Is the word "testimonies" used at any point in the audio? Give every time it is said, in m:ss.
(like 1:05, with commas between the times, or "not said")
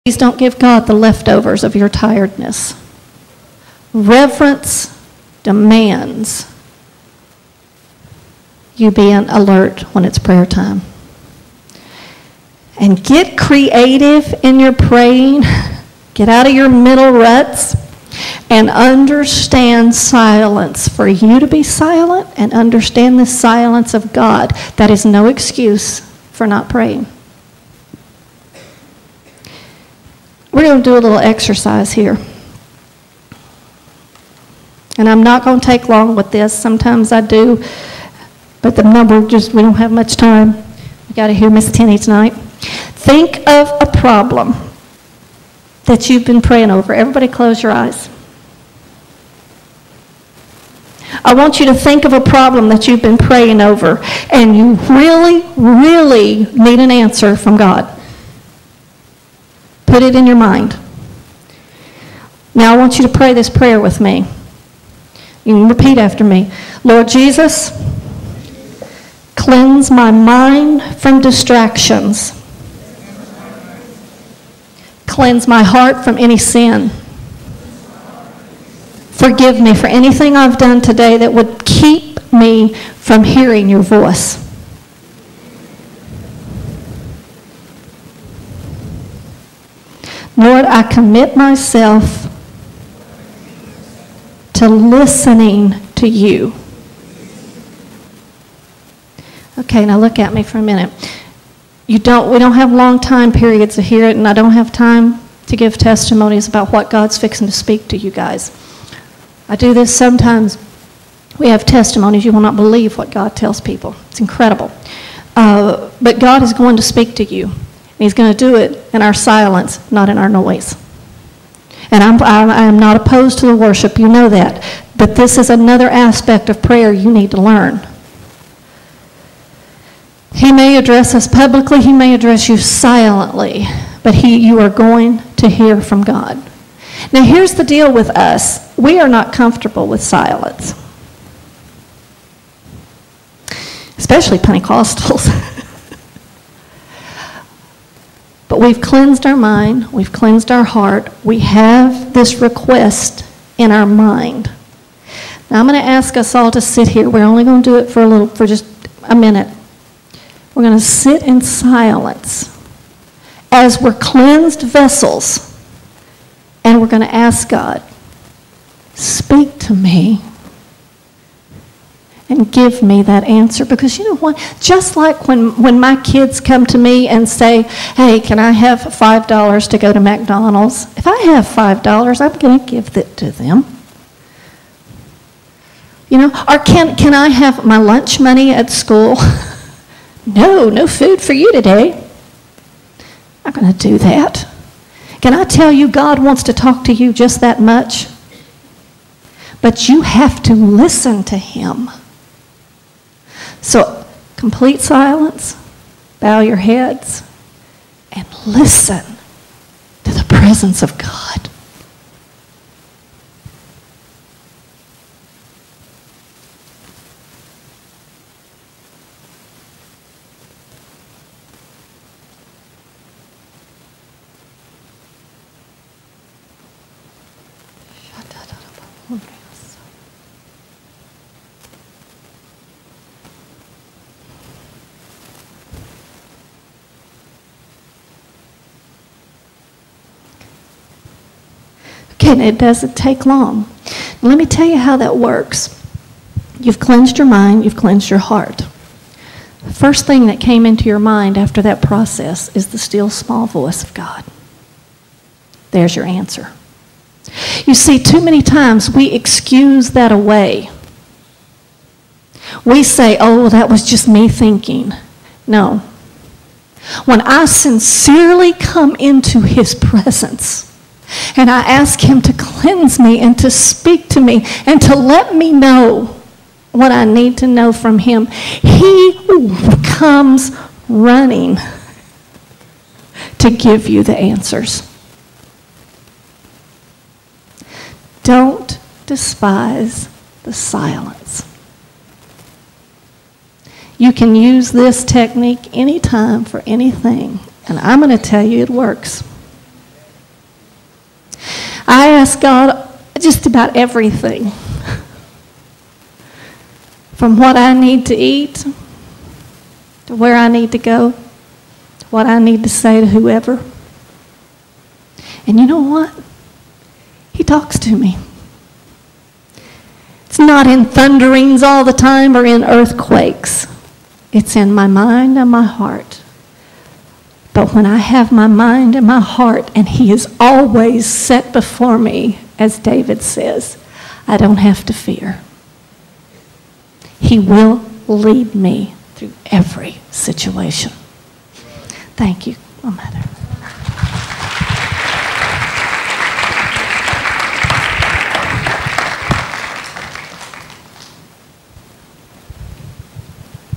1:45, 1:51.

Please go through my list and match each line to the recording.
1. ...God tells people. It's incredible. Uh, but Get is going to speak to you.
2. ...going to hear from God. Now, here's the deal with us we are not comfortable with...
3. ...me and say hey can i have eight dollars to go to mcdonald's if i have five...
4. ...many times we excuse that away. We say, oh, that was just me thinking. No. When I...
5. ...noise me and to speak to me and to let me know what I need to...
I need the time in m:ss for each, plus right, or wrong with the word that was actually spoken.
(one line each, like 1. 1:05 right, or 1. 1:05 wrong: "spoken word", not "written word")
1. 1:53 wrong: "God", not "Get"
2. 2:14 right
3. 2:56 wrong: "five", not "eight"
4. 4:18 right
5. 4:32 wrong: "cleanse", not "noise".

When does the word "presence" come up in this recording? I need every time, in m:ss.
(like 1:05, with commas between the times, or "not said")
3:30, 4:29.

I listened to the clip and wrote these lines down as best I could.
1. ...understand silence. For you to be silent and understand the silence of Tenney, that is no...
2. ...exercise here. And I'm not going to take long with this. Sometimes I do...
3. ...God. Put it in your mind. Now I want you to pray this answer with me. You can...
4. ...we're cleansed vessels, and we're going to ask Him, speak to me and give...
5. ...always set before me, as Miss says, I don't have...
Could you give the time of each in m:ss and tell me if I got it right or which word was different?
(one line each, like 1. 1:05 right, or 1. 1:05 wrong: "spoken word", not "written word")
1. 0:18 wrong: "God", not "Tenney"
2. 0:31 right
3. 0:57 wrong: "prayer", not "answer"
4. 2:43 wrong: "God", not "Him"
5. 5:30 wrong: "David", not "Miss".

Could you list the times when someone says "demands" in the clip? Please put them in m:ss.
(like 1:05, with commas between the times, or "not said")
0:05.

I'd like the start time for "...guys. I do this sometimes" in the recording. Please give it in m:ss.
1:48.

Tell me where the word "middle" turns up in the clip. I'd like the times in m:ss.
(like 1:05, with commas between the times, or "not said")
0:16.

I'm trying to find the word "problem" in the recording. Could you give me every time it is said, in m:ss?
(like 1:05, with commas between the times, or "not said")
0:43, 0:52.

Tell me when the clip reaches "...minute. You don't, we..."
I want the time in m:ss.
1:40.